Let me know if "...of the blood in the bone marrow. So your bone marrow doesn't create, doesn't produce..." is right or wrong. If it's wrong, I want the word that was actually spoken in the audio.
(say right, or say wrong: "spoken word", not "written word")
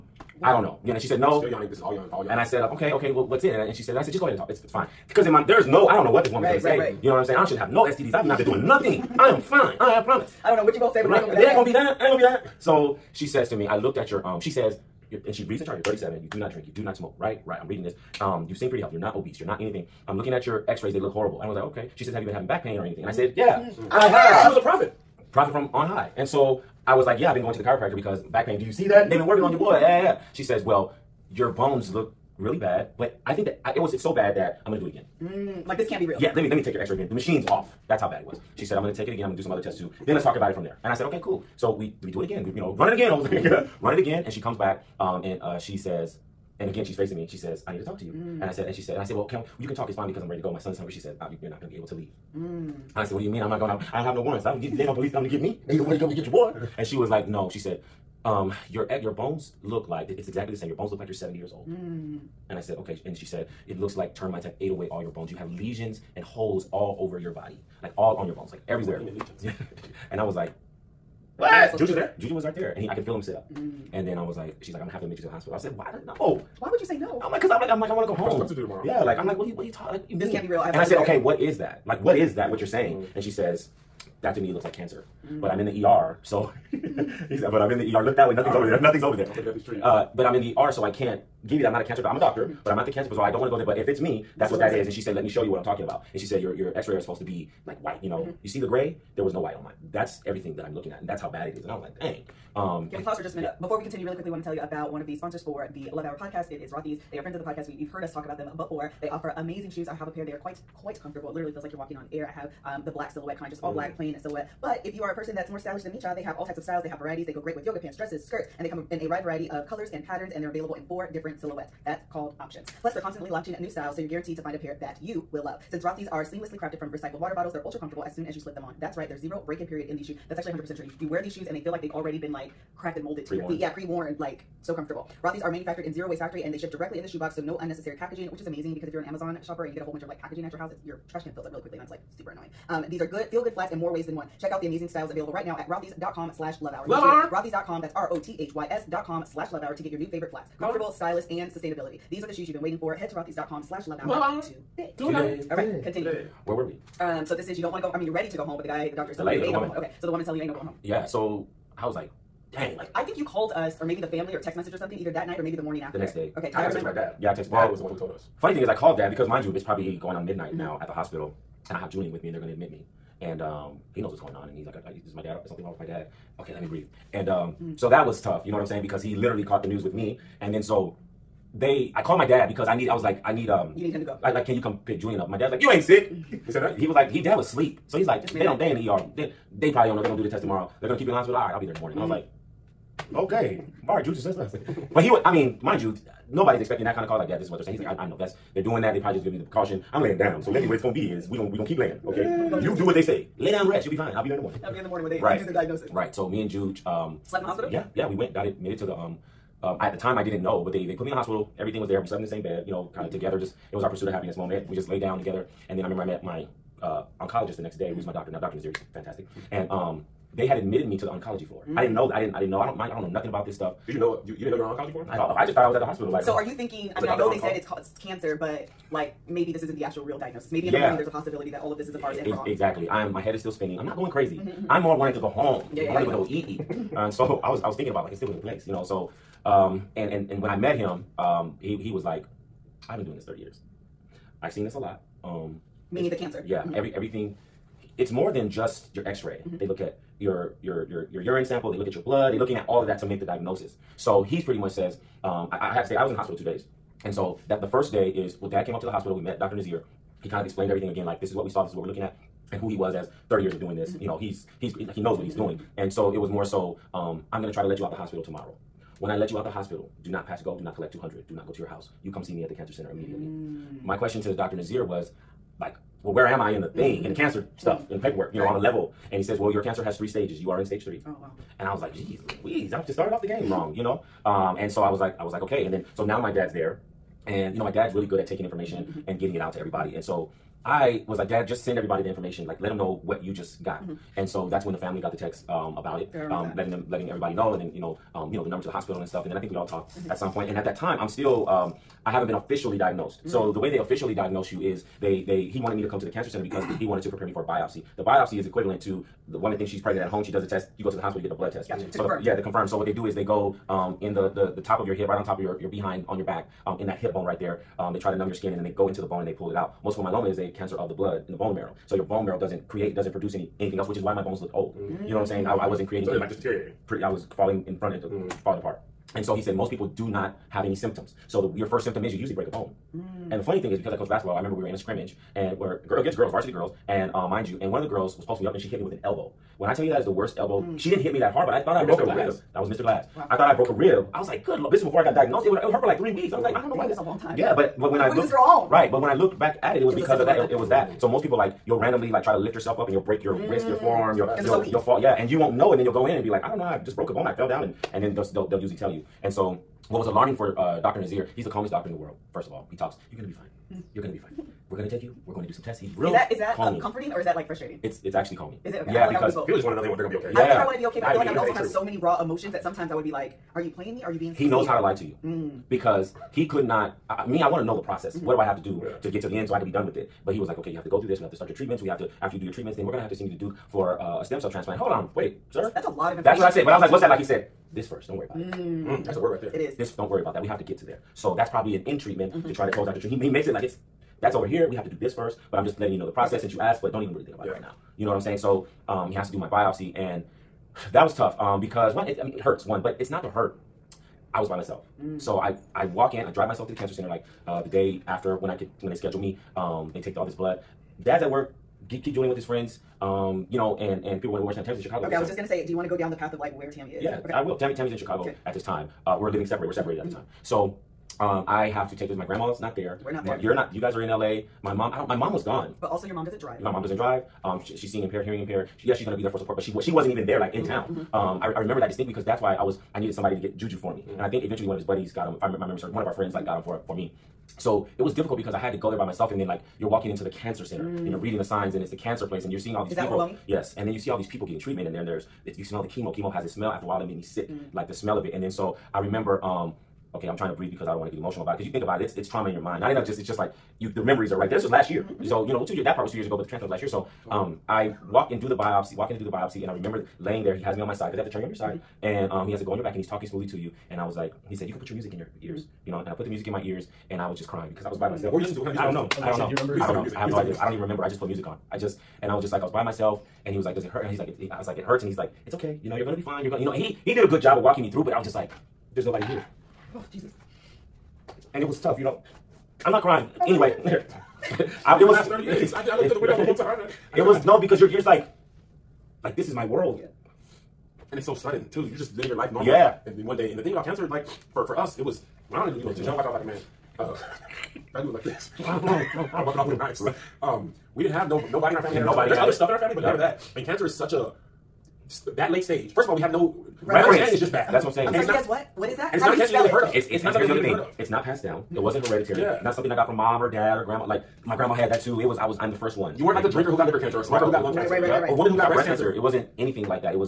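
right.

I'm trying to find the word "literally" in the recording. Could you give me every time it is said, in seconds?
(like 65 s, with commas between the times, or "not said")
111 s, 179 s.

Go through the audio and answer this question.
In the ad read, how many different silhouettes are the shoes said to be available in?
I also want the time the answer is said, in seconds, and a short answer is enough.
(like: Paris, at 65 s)
4, at 120 s.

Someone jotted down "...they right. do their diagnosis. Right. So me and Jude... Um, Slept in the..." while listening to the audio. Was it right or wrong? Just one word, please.
right.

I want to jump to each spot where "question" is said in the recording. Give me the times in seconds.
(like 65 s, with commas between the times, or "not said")
273 s.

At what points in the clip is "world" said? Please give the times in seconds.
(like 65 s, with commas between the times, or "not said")
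361 s, 489 s.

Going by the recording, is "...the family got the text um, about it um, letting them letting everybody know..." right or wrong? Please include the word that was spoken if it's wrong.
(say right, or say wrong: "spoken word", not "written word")
right.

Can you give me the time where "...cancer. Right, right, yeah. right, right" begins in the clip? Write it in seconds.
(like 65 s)
517 s.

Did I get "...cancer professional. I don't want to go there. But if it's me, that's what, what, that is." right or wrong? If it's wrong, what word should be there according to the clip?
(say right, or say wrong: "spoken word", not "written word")
right.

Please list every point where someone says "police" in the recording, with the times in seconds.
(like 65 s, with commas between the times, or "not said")
54 s.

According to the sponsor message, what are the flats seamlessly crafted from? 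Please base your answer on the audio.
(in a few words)
Recycled water bottles.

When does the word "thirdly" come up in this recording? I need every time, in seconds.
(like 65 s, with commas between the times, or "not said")
not said.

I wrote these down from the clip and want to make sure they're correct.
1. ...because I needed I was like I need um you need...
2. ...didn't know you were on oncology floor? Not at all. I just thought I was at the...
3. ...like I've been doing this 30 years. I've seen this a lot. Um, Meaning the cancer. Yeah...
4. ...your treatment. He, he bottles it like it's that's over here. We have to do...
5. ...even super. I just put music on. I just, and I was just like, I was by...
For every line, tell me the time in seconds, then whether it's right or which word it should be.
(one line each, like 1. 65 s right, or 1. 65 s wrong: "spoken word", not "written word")
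1. 182 s right
2. 224 s right
3. 242 s right
4. 392 s wrong: "makes", not "bottles"
5. 470 s wrong: "remember", not "super".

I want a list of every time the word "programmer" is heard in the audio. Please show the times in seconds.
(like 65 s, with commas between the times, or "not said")
not said.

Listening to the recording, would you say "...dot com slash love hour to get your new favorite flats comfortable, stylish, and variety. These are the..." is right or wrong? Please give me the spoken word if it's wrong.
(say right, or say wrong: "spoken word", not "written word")
wrong: "sustainability", not "variety".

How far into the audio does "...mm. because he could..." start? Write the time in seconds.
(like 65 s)
375 s.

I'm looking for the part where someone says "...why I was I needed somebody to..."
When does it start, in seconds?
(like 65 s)
432 s.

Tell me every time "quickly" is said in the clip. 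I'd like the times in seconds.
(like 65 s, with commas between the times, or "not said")
104 s, 141 s.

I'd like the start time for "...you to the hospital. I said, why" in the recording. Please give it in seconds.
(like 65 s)
75 s.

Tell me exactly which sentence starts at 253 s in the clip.
So he's pretty much says, um, I, I had to stay.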